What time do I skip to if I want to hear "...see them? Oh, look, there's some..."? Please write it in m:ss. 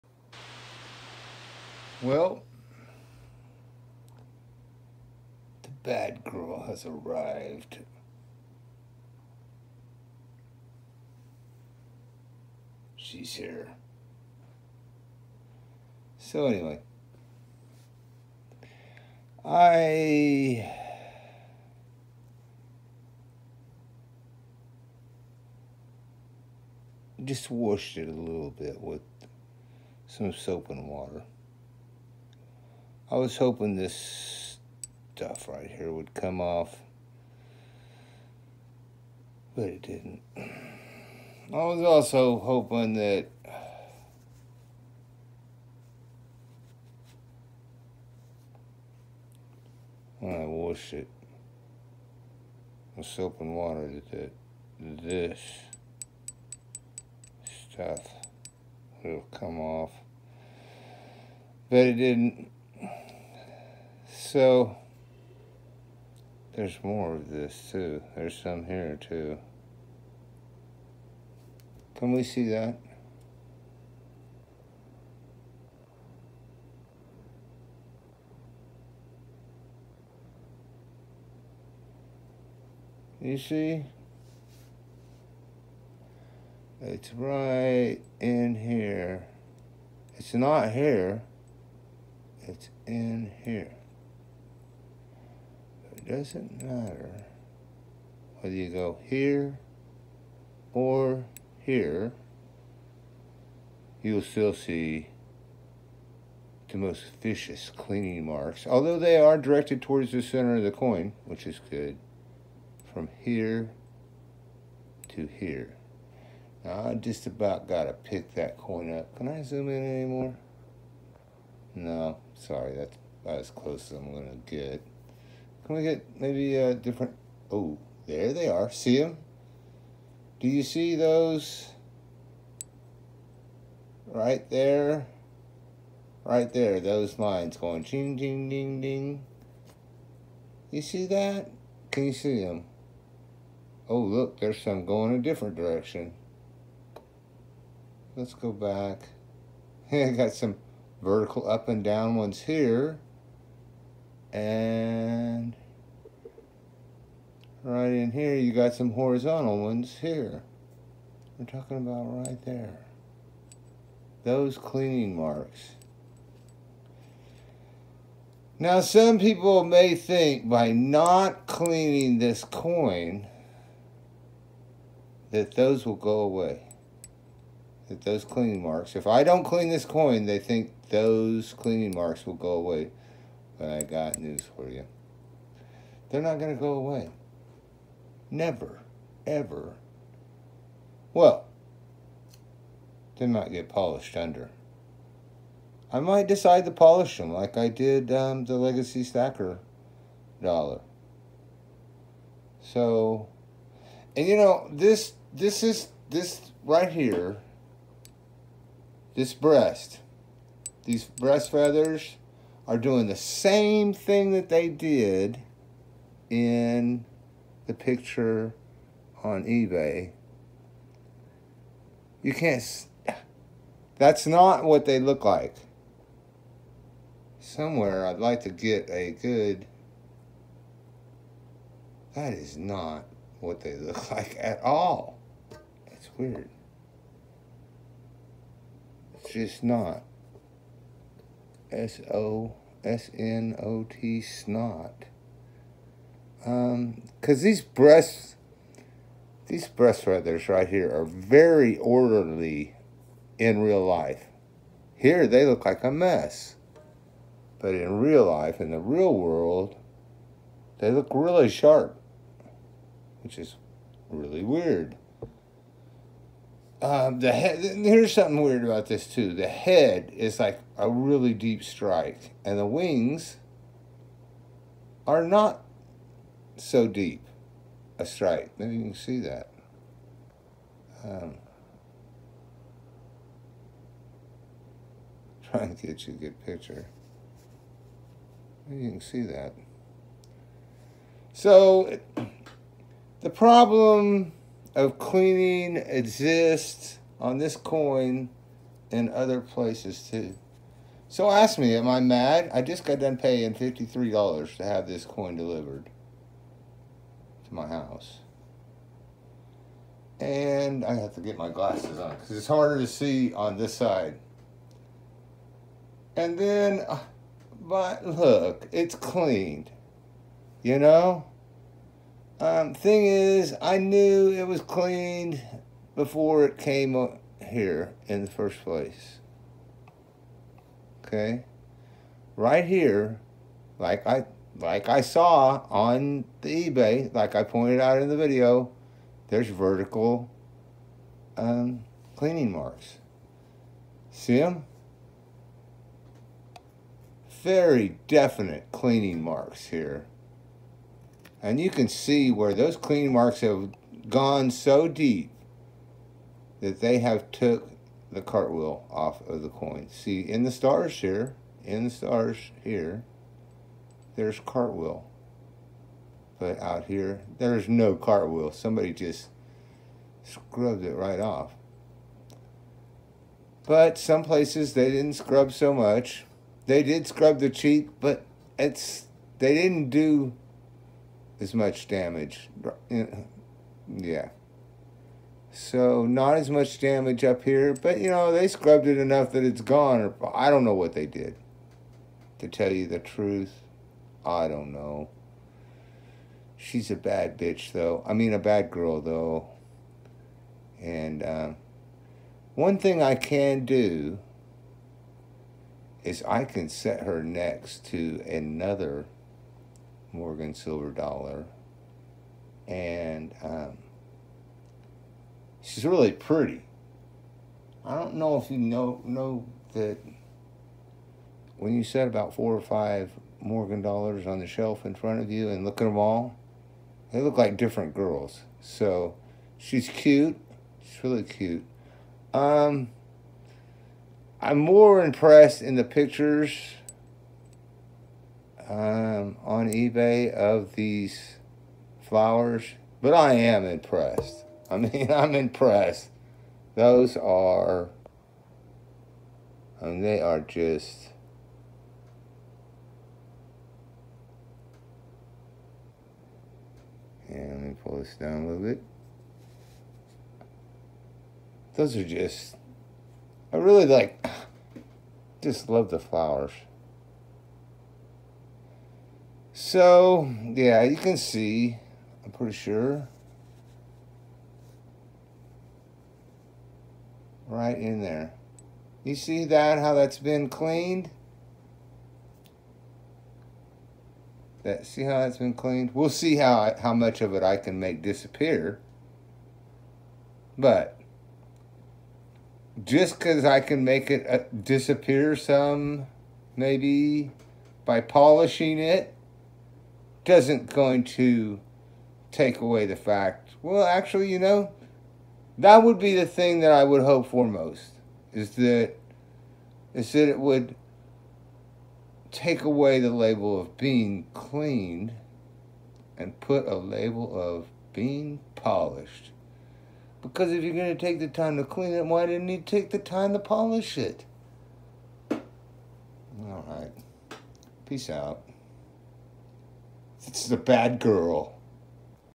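2:22.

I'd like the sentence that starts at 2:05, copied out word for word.
Can we get maybe a different...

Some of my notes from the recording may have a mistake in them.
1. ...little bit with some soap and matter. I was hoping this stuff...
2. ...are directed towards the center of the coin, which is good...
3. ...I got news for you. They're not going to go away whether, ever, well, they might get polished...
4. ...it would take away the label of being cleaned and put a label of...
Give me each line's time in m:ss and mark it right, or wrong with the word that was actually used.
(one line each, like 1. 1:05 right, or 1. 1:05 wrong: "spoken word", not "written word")
1. 0:28 wrong: "water", not "matter"
2. 1:49 right
3. 3:03 wrong: "never", not "whether"
4. 8:30 right.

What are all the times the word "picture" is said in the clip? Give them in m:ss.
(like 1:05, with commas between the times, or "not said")
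3:37, 4:46, 7:15.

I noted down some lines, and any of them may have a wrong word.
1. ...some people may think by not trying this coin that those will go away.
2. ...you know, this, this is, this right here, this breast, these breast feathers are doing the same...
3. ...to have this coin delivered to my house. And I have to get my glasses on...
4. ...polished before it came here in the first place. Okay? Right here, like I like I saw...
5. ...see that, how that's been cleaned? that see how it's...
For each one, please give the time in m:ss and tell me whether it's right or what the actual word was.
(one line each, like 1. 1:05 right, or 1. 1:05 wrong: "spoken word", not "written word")
1. 2:48 wrong: "cleaning", not "trying"
2. 3:24 right
3. 5:04 right
4. 5:24 wrong: "cleaned", not "polished"
5. 7:59 right.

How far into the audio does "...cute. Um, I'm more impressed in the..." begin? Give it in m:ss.
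7:11.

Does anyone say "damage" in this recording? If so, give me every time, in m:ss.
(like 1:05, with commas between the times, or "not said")
6:21, 6:26.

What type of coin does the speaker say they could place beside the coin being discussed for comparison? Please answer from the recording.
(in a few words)
Morgan Silver Dollar.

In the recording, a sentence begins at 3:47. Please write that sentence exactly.
Somewhere I'd like to get a good.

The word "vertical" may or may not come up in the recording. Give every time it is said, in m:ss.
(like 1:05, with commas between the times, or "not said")
2:31, 5:39.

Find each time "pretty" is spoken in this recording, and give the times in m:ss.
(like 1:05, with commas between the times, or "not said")
6:56, 7:52.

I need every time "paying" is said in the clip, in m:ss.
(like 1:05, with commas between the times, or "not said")
5:03.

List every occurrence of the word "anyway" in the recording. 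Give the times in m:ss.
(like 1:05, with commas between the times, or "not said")
0:16.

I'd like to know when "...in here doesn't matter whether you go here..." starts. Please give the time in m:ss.
1:32.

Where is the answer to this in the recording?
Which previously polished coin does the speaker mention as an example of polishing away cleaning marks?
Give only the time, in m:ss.
3:18.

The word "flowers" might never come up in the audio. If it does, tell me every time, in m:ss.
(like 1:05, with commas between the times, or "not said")
7:22, 7:45.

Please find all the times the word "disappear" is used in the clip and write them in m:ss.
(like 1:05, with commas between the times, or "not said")
8:08, 8:14.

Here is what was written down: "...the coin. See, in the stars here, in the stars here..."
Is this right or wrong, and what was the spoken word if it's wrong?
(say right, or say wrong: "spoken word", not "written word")
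right.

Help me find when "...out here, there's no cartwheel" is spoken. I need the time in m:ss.
6:06.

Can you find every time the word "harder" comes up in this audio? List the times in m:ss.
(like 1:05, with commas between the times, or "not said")
5:12.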